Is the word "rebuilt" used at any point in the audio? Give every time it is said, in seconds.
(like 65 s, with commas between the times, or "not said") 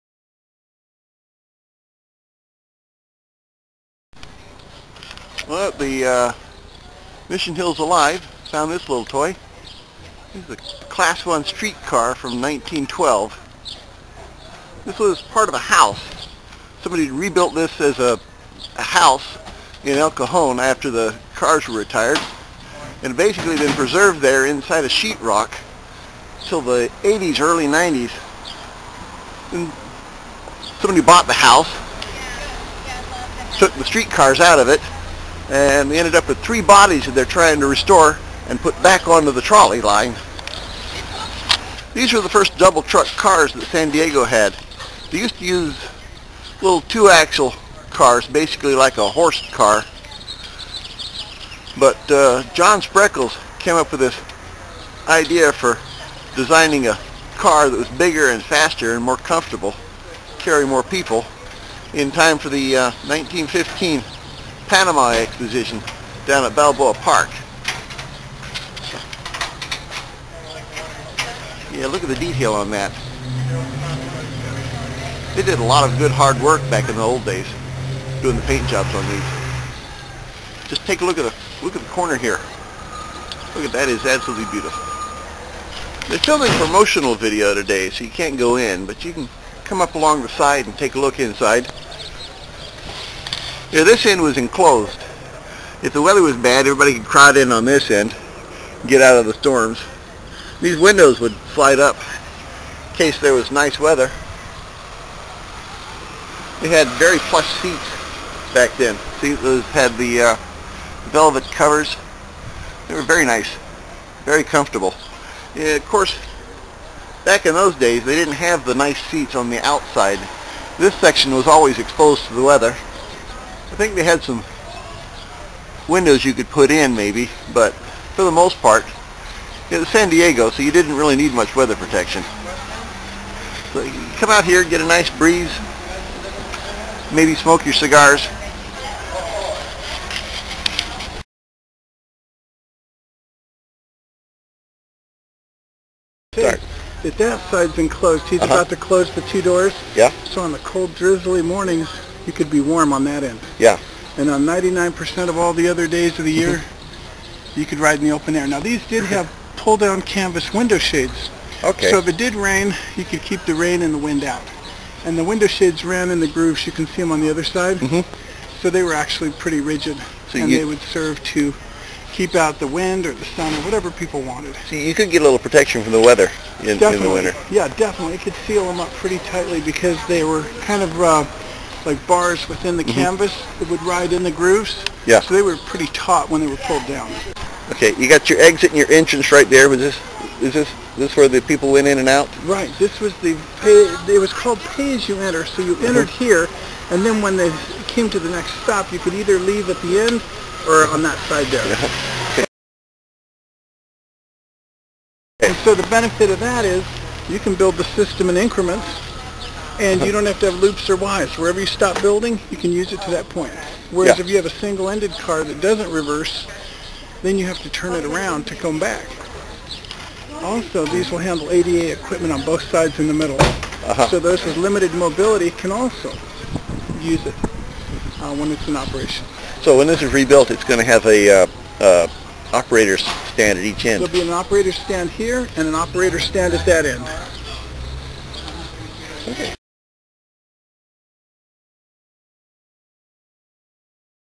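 17 s, 230 s.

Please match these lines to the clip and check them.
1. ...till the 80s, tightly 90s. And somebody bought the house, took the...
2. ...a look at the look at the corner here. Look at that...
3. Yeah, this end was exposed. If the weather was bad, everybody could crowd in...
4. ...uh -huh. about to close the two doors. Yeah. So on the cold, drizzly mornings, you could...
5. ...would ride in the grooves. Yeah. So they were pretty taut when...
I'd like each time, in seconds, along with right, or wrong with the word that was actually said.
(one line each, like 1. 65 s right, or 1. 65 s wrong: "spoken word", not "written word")
1. 26 s wrong: "early", not "tightly"
2. 81 s right
3. 93 s wrong: "enclosed", not "exposed"
4. 148 s right
5. 183 s right.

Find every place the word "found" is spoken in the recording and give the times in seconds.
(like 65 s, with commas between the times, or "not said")
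8 s.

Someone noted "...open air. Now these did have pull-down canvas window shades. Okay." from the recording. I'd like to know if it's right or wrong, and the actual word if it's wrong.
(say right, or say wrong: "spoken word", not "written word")
right.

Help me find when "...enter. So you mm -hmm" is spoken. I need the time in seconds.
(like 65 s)
195 s.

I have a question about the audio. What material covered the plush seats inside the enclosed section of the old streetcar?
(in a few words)
Velvet.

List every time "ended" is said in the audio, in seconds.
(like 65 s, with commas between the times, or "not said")
35 s, 214 s.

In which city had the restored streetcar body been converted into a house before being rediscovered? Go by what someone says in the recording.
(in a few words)
El Cajon.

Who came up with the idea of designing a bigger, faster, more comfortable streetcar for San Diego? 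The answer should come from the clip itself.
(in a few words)
John Spreckels.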